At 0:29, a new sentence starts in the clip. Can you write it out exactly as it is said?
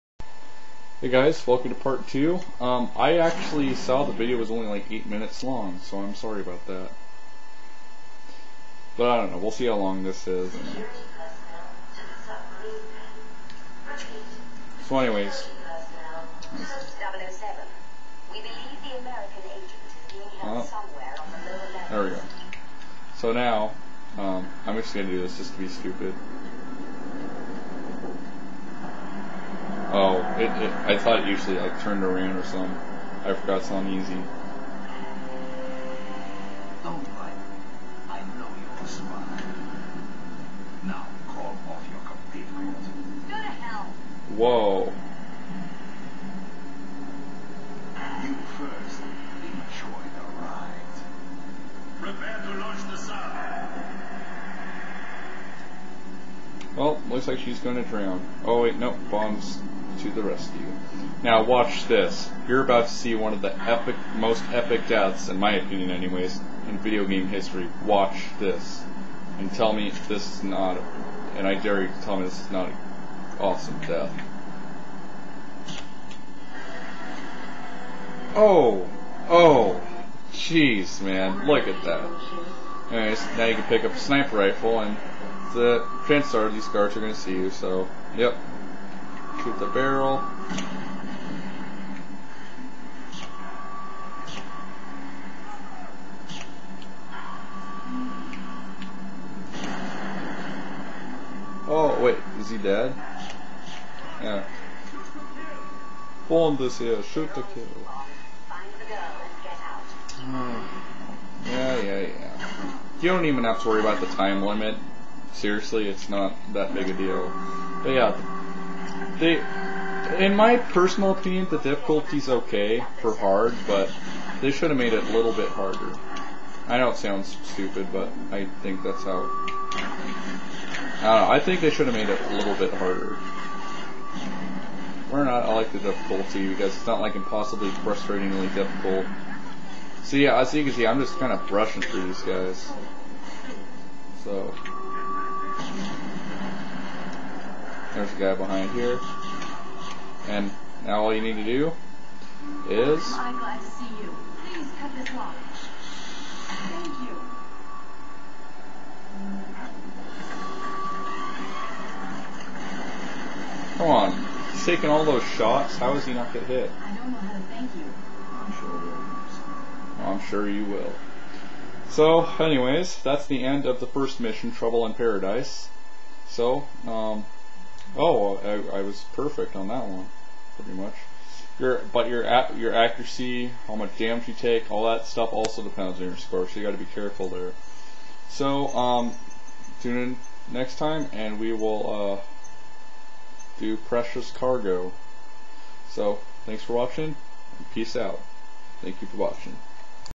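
Oh, it, it, I thought it usually like turned around or something.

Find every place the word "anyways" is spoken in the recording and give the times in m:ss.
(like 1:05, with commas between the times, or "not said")
0:14, 1:05, 1:22, 2:52.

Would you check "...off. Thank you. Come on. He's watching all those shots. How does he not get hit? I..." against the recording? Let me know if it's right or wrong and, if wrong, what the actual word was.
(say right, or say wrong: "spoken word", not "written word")
wrong: "taking", not "watching".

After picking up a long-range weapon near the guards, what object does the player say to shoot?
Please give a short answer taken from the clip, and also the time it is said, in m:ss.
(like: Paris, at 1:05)
The barrel, at 1:29.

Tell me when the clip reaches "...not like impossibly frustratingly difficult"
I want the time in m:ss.
2:16.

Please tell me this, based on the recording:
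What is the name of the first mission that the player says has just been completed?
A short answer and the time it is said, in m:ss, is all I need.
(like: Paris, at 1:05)
Trouble in Paradise, at 2:54.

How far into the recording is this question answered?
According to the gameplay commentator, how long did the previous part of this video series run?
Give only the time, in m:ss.
0:04.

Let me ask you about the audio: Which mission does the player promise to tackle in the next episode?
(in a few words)
Precious Cargo.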